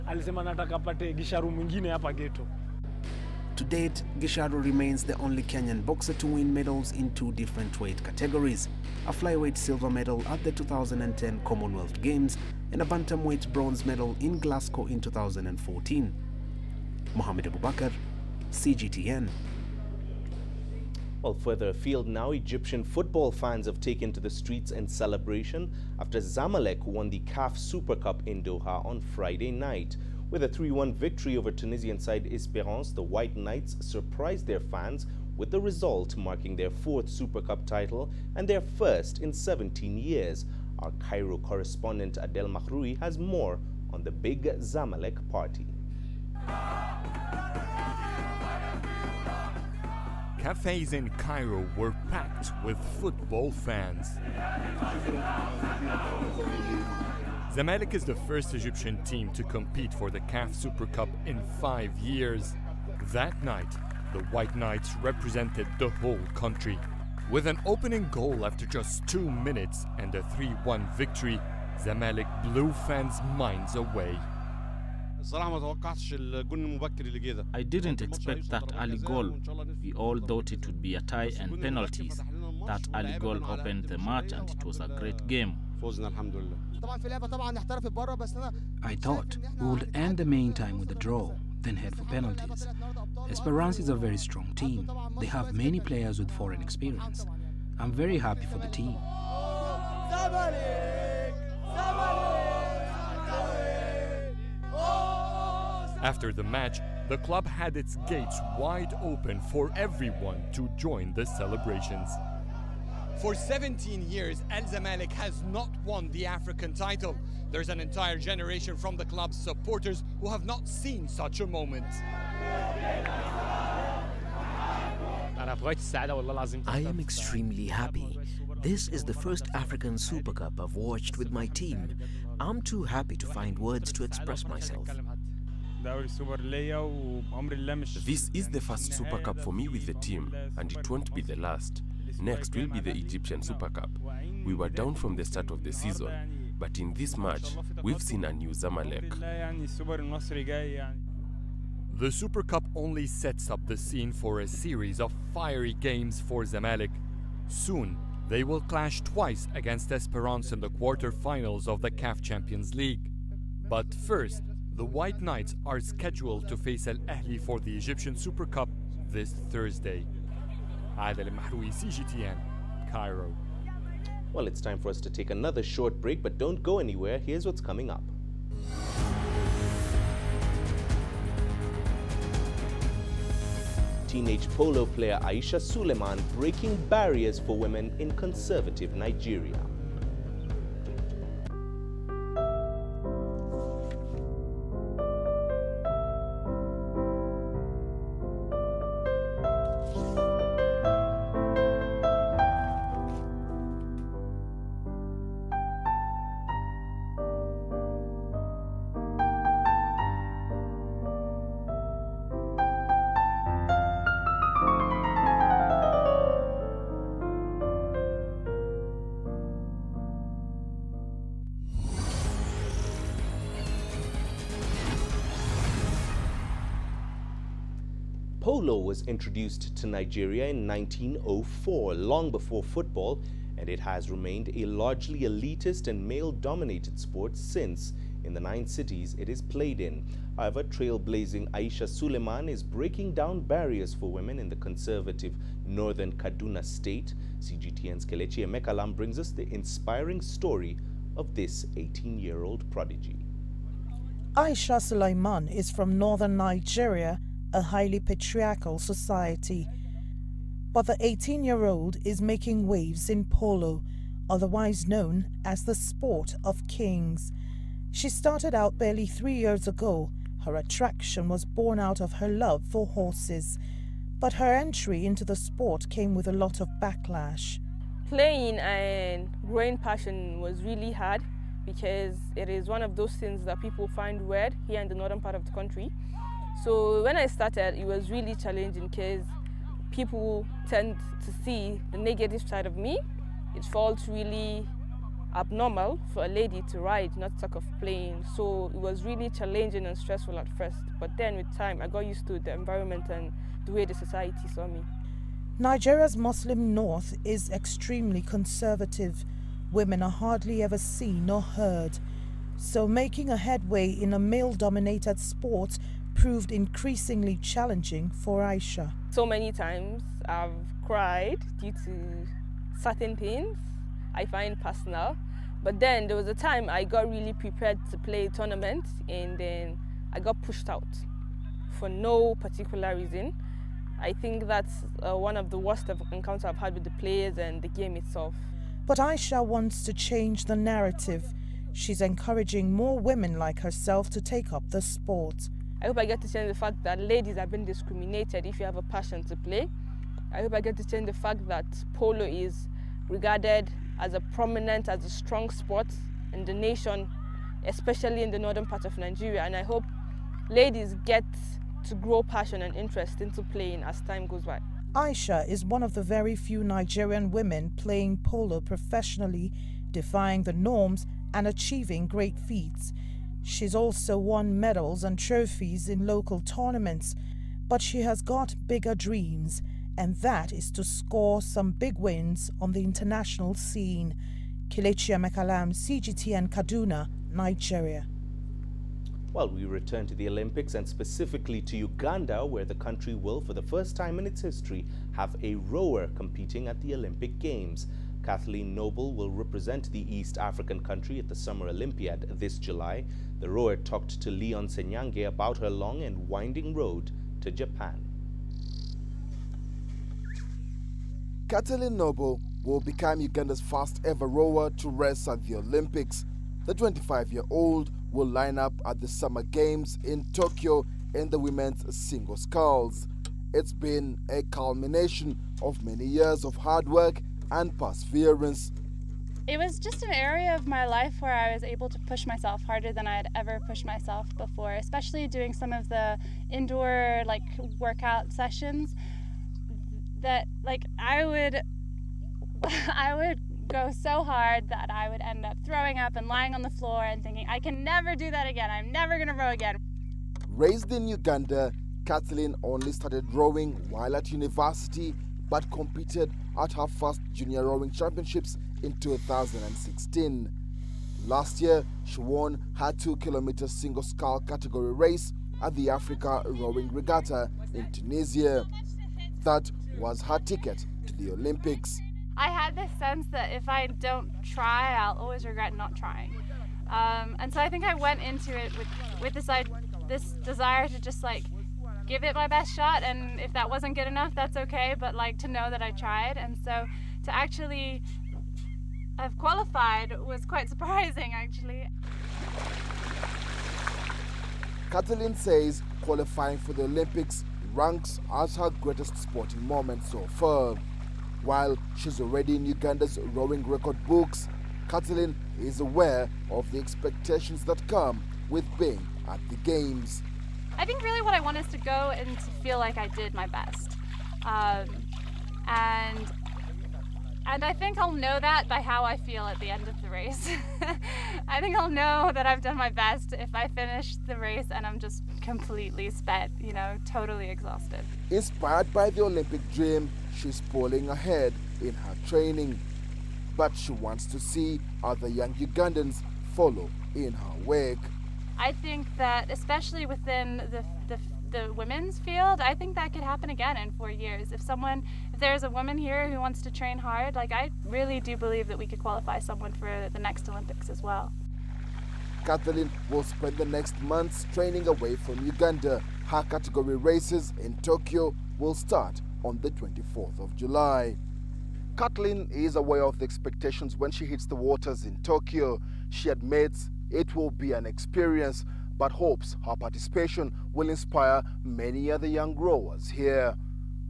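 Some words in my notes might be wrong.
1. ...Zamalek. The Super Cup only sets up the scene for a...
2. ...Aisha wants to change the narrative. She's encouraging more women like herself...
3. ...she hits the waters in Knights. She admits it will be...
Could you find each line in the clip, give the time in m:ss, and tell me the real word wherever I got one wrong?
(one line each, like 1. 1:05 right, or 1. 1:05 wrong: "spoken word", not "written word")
1. 2:28 right
2. 5:38 right
3. 9:24 wrong: "Tokyo", not "Knights".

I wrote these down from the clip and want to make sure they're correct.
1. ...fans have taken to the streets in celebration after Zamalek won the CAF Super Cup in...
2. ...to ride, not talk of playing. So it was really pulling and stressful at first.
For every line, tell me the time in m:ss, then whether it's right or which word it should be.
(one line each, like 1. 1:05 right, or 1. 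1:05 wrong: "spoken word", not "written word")
1. 0:23 right
2. 4:56 wrong: "challenging", not "pulling".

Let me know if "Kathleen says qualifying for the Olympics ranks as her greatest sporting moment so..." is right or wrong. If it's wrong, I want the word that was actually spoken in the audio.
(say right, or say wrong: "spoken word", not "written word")
right.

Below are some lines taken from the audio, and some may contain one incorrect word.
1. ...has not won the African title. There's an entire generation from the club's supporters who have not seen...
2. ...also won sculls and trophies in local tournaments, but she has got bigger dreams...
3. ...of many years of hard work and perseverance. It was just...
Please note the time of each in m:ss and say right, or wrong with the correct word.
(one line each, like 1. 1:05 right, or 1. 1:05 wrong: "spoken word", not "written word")
1. 1:55 right
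2. 6:13 wrong: "medals", not "sculls"
3. 7:05 right.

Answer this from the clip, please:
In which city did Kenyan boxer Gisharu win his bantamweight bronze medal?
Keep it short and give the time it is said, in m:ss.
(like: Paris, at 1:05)
Glasgow, at 0:14.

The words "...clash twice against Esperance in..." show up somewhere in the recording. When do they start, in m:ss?
2:38.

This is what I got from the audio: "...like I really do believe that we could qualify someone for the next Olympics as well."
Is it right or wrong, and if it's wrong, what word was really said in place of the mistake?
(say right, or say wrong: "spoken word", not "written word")
right.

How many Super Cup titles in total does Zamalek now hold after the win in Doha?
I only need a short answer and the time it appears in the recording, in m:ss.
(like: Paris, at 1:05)
4, at 0:36.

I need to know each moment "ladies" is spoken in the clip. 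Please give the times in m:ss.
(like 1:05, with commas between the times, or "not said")
5:46, 6:00.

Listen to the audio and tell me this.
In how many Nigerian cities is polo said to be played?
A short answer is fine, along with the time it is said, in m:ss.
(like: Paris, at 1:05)
9, at 3:58.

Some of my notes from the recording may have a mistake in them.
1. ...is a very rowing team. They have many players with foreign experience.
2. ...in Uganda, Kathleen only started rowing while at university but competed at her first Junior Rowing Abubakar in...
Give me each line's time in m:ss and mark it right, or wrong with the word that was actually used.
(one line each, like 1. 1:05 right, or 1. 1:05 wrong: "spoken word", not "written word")
1. 1:33 wrong: "strong", not "rowing"
2. 7:30 wrong: "Championships", not "Abubakar".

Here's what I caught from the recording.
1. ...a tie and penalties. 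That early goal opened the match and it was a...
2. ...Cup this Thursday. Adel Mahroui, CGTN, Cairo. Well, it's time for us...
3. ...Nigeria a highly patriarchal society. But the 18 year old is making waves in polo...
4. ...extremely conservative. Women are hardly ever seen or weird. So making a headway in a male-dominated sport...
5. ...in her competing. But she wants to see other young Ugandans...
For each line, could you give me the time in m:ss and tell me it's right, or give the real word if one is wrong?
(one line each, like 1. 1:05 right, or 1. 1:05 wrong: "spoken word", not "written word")
1. 1:20 right
2. 2:48 right
3. 4:16 right
4. 5:07 wrong: "heard", not "weird"
5. 8:51 wrong: "training", not "competing".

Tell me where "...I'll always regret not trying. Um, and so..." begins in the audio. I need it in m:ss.
7:54.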